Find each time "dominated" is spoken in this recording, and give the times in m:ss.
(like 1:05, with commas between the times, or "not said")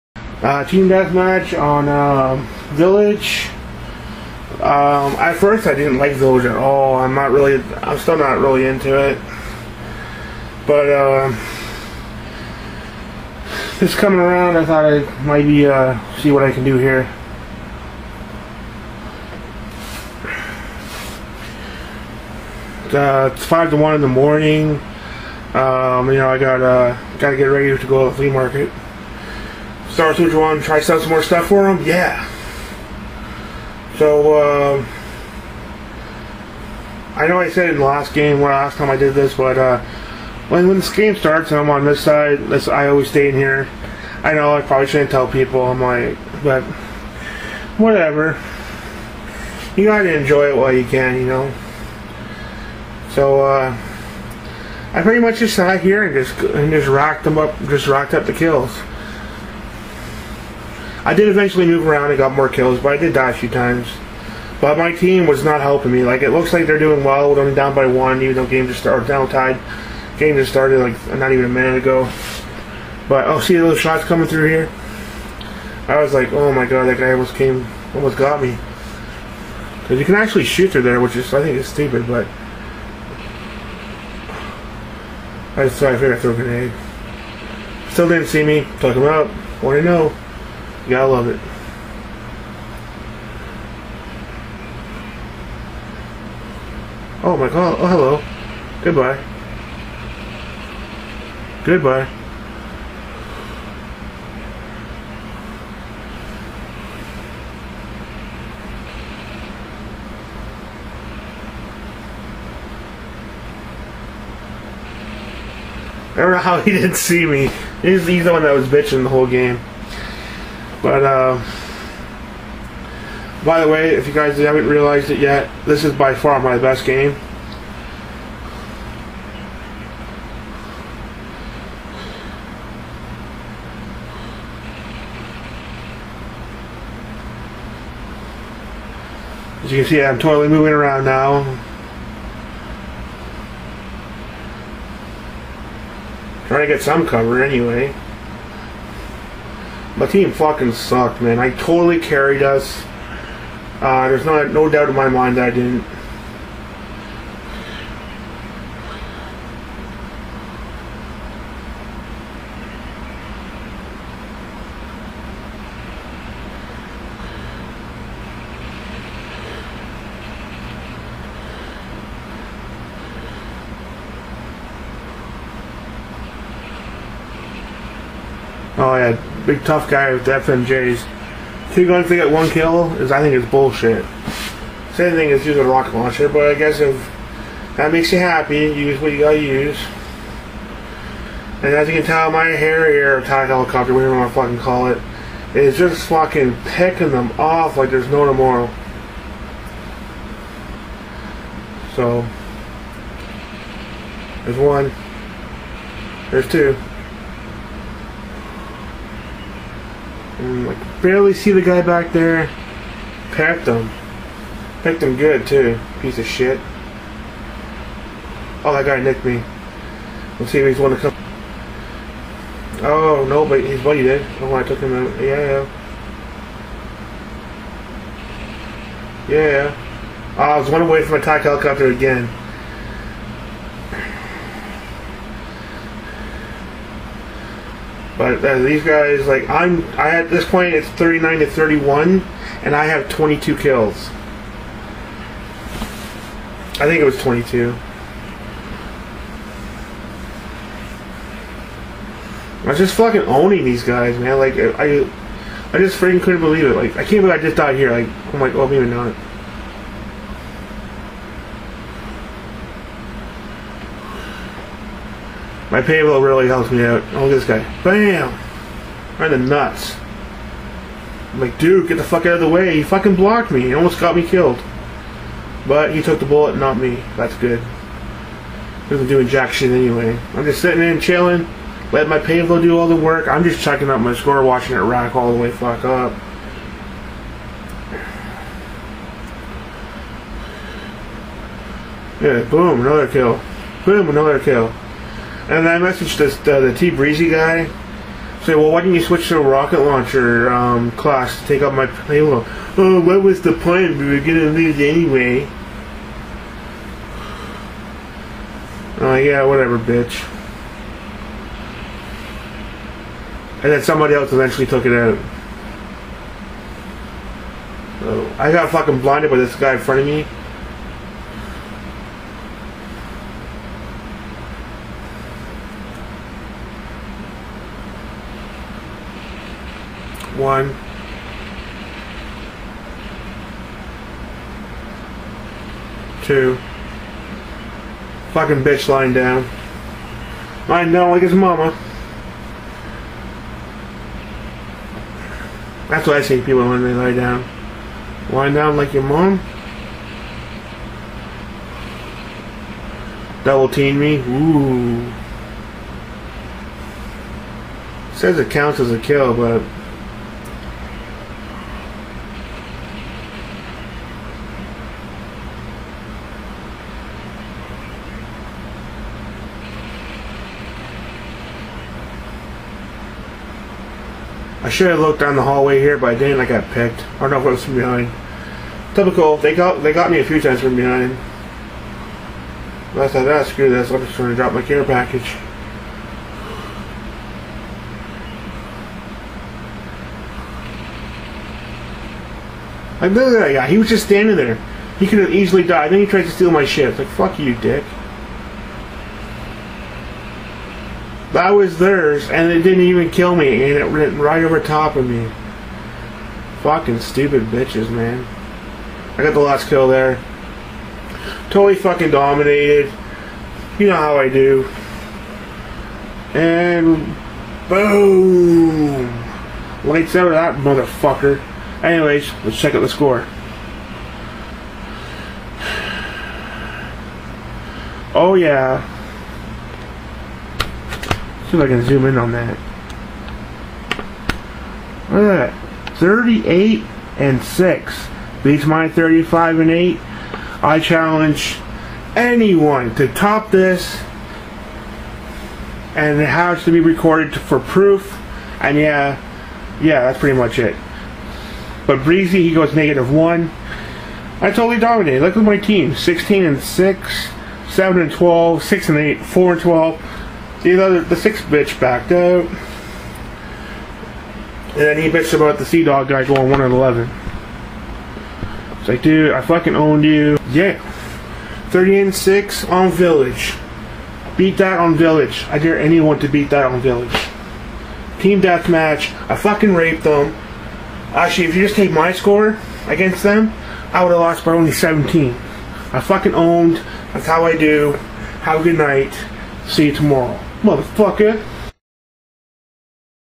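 6:52, 7:34.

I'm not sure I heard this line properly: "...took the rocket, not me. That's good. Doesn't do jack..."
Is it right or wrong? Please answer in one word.
wrong.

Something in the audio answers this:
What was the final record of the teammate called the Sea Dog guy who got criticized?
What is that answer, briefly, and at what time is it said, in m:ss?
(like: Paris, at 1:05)
1 and 11, at 7:46.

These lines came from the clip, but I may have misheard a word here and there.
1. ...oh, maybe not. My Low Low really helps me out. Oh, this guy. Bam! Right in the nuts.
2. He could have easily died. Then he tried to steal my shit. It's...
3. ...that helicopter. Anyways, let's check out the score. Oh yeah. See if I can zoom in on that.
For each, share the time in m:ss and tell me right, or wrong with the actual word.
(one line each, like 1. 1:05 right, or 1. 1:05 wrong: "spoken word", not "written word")
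1. 4:18 wrong: "Pave", not "Low"
2. 6:34 right
3. 7:00 wrong: "motherfucker", not "helicopter".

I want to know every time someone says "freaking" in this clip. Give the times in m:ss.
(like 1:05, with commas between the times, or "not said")
4:15.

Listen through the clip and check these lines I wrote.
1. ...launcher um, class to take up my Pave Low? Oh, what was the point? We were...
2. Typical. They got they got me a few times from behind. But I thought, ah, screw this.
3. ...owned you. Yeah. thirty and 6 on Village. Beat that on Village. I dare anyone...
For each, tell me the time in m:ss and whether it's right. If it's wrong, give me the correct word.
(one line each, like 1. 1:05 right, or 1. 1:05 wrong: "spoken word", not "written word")
1. 4:59 right
2. 6:18 right
3. 7:49 right.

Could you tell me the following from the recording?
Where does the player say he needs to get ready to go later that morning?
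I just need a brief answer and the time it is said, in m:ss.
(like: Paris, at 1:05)
flea market, at 0:28.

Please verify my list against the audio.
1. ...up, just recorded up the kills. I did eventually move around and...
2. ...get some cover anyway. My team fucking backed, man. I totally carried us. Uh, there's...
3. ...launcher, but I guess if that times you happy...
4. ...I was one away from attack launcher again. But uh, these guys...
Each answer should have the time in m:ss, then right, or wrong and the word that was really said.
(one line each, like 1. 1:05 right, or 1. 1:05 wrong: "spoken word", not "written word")
1. 0:57 wrong: "racked", not "recorded"
2. 2:26 wrong: "sucked", not "backed"
3. 3:05 wrong: "makes", not "times"
4. 3:50 wrong: "helicopter", not "launcher".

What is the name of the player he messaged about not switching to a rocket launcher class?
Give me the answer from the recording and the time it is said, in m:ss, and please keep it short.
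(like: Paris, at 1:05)
T Breezy, at 4:56.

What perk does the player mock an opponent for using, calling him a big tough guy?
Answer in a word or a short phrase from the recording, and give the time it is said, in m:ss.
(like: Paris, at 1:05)
FMJs, at 3:00.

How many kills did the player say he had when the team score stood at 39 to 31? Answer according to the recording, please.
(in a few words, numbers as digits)
22.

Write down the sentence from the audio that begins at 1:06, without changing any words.
Like, it looks like they're doing well.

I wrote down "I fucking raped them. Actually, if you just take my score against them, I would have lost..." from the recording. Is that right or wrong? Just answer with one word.
right.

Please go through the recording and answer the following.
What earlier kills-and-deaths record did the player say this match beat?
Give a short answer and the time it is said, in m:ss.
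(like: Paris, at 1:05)
35 and 8, at 7:18.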